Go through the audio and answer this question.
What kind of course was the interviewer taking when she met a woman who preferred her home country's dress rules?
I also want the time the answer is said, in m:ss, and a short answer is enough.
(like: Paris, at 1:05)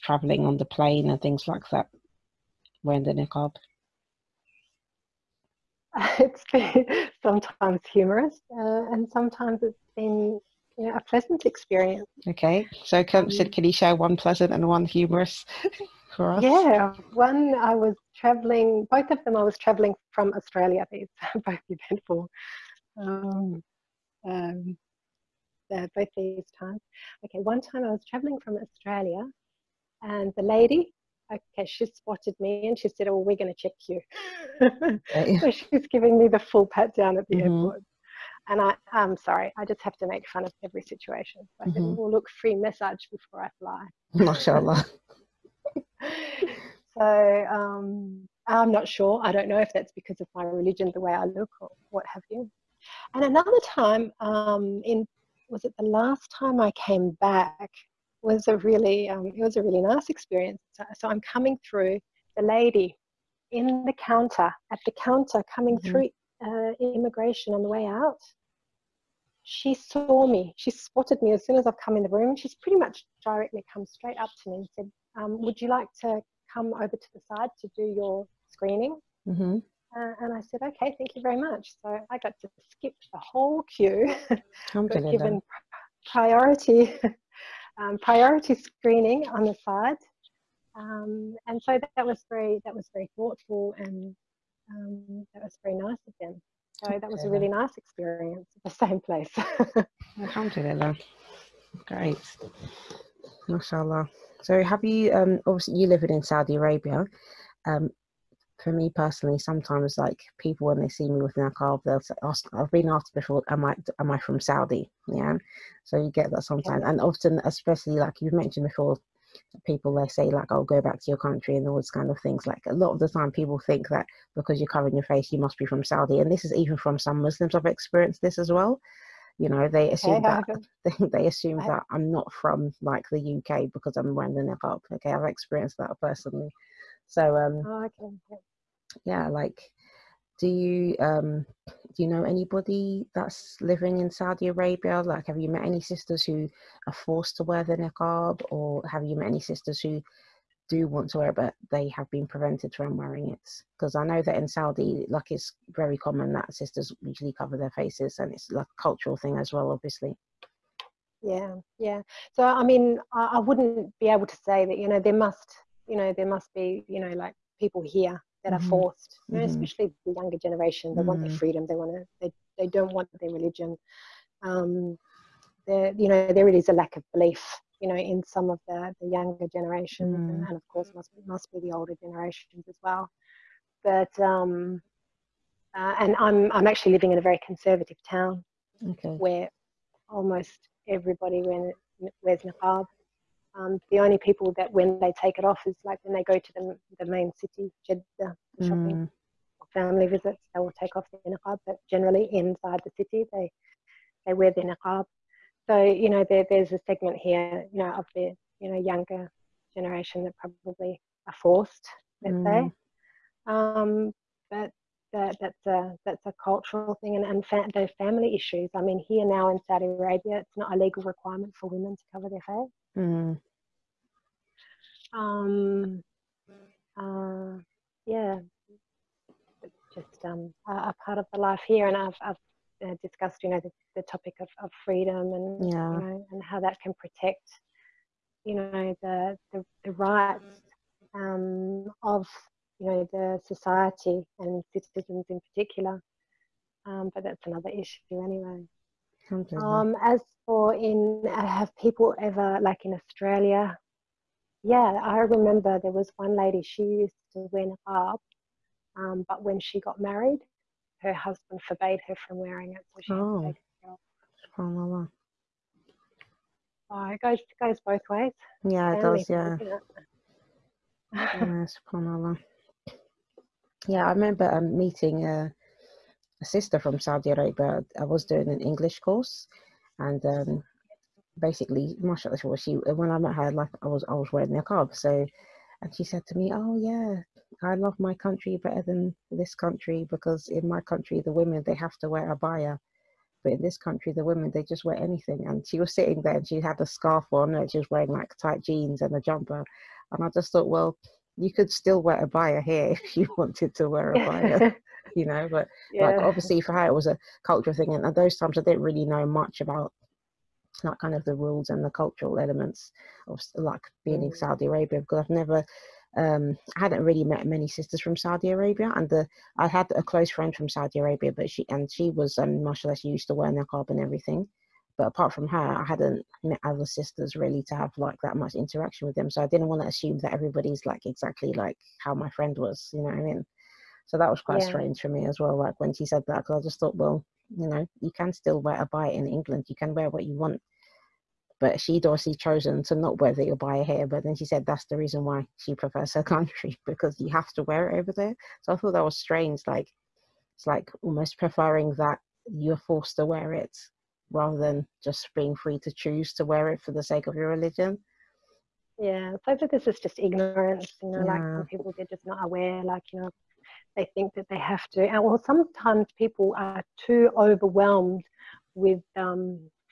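English course, at 4:38.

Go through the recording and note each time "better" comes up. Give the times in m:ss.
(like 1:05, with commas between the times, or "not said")
4:48.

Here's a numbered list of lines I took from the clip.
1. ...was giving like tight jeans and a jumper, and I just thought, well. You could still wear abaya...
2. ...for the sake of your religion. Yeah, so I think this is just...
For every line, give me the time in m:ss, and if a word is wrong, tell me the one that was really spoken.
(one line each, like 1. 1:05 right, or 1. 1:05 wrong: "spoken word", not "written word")
1. 4:57 wrong: "wearing", not "giving"
2. 5:56 right.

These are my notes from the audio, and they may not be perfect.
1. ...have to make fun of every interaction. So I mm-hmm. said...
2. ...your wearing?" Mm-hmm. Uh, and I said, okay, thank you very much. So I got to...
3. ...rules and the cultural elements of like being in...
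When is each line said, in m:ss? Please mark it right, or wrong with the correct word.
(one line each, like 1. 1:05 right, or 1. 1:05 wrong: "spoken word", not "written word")
1. 0:39 wrong: "situation", not "interaction"
2. 1:17 wrong: "screening", not "wearing"
3. 5:11 right.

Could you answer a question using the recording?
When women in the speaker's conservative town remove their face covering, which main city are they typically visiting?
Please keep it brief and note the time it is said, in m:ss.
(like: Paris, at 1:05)
Jeddah, at 3:17.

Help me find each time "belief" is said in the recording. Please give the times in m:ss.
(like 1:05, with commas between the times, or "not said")
2:57.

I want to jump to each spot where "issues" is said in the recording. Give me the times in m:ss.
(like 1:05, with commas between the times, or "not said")
3:38, 4:07.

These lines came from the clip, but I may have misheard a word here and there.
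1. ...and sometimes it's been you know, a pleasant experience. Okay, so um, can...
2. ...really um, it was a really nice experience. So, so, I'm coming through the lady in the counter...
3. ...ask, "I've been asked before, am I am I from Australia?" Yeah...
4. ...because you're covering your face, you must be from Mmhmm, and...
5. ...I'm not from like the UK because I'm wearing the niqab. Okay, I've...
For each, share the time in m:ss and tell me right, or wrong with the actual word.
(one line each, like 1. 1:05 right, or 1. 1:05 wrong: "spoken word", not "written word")
1. 0:08 right
2. 0:58 right
3. 1:52 wrong: "Saudi", not "Australia"
4. 2:04 wrong: "Saudi", not "Mmhmm"
5. 2:11 right.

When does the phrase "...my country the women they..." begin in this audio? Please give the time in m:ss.
4:50.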